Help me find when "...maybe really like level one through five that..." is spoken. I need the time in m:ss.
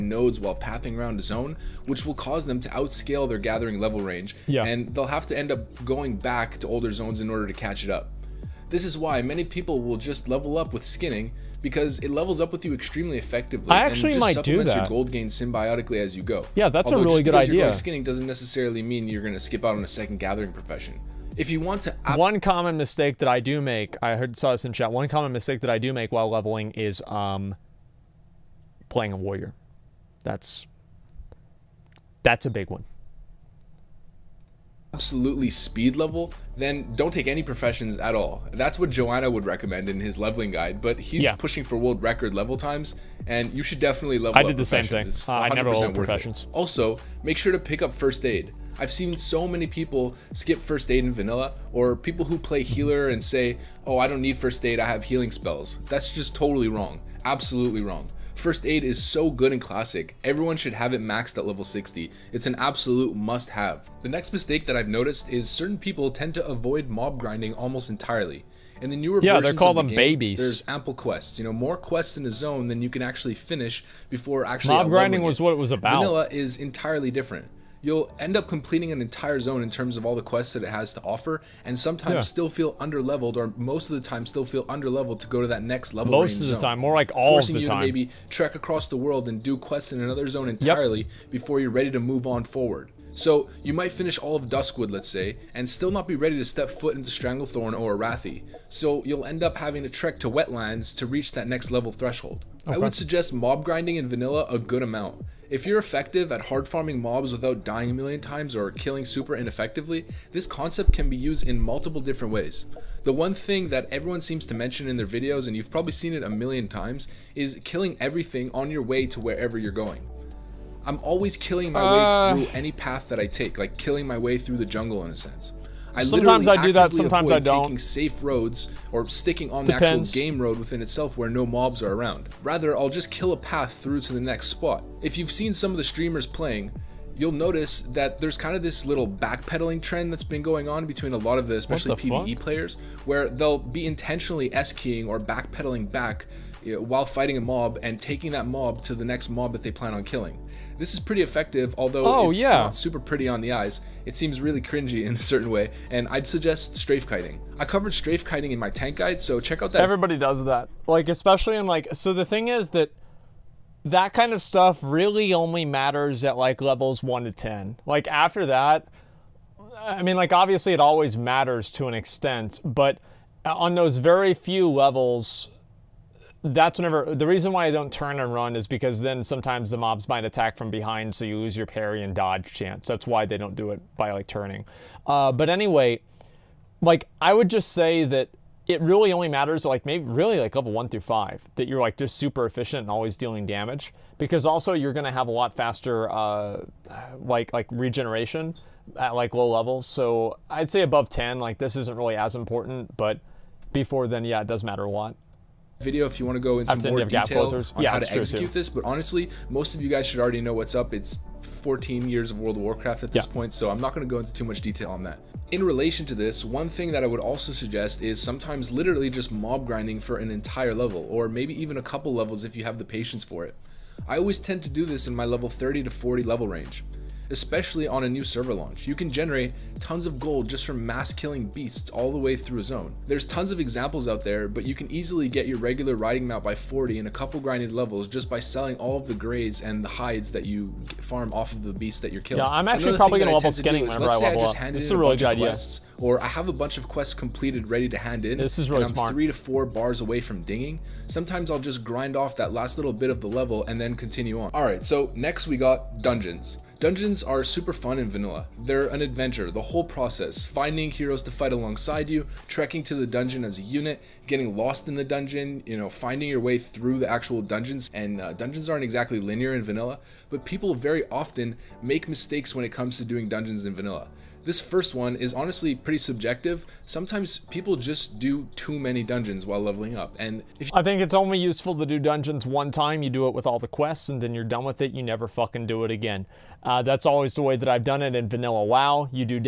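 3:09.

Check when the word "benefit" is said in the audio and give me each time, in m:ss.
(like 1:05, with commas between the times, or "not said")
not said.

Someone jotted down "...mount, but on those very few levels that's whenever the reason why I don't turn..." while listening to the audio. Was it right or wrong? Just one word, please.
wrong.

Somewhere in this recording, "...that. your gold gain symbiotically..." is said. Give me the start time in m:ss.
0:14.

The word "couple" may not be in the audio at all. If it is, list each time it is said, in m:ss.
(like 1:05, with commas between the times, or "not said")
3:41, 3:57.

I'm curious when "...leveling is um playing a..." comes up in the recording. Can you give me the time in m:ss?
0:26.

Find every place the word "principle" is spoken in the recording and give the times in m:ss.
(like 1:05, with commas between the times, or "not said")
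not said.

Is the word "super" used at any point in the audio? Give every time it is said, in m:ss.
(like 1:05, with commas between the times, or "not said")
1:49, 2:32, 3:12, 4:17.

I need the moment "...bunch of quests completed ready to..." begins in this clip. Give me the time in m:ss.
4:06.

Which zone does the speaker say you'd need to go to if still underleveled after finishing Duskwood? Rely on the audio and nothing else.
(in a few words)
Wetlands.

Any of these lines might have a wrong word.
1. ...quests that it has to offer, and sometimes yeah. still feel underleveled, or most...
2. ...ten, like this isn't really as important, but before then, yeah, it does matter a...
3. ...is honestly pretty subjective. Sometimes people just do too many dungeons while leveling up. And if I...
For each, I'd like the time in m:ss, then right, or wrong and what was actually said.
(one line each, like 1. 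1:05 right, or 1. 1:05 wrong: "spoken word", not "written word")
1. 1:20 right
2. 3:21 right
3. 4:35 right.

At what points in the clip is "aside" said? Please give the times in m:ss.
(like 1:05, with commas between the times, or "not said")
not said.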